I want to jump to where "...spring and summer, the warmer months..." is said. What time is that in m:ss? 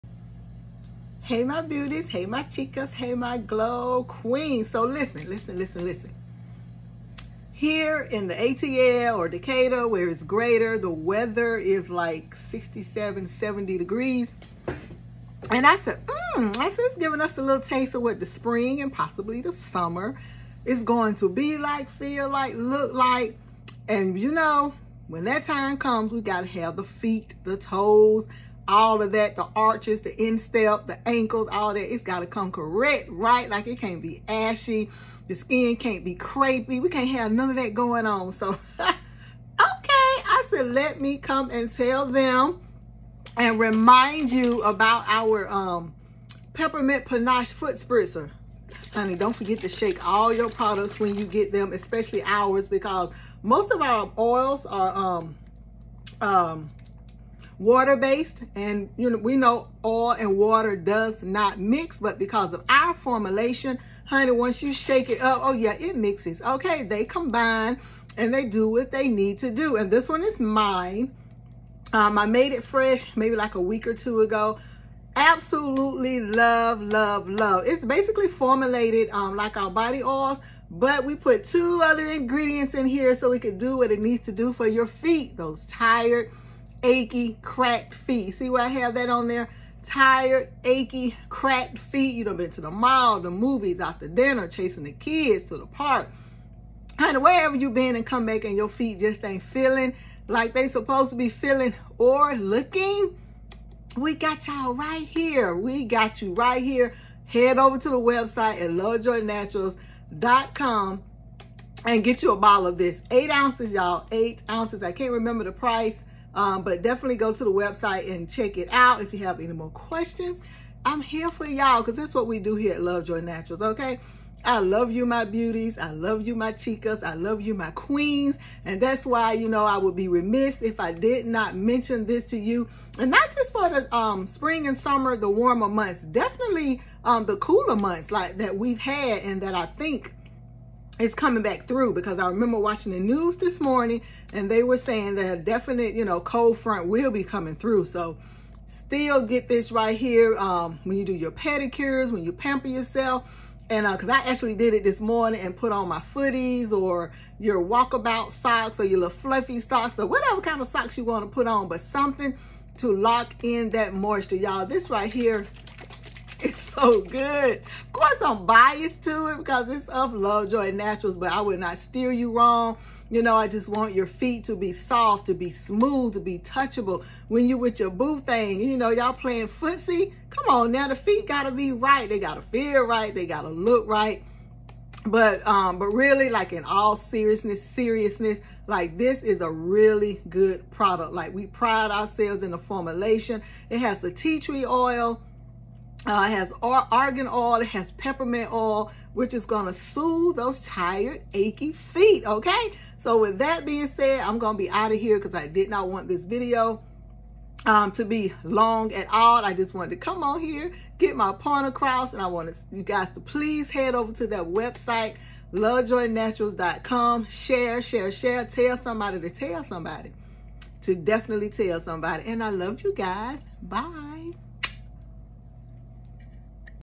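2:14.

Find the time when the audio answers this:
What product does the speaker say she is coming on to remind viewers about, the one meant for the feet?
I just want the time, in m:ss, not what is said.
0:46.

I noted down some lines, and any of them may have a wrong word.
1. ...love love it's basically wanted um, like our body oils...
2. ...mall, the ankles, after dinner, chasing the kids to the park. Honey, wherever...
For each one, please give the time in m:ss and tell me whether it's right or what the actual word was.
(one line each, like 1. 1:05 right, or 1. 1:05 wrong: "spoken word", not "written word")
1. 1:16 wrong: "formulated", not "wanted"
2. 1:32 wrong: "movies", not "ankles".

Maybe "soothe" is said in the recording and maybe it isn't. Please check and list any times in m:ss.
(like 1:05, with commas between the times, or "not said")
3:19.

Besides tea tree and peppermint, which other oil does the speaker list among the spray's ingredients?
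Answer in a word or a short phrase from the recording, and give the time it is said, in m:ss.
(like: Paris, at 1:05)
Argan oil, at 3:16.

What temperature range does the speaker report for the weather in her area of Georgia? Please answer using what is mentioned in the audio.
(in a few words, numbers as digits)
67 to 70 degrees.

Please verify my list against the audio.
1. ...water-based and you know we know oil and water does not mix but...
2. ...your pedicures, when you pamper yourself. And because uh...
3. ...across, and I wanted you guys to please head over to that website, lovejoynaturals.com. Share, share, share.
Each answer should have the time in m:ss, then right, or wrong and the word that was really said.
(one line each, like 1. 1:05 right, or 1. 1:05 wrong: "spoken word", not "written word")
1. 0:57 right
2. 2:31 right
3. 3:31 right.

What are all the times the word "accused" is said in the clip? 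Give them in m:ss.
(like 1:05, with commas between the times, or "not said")
not said.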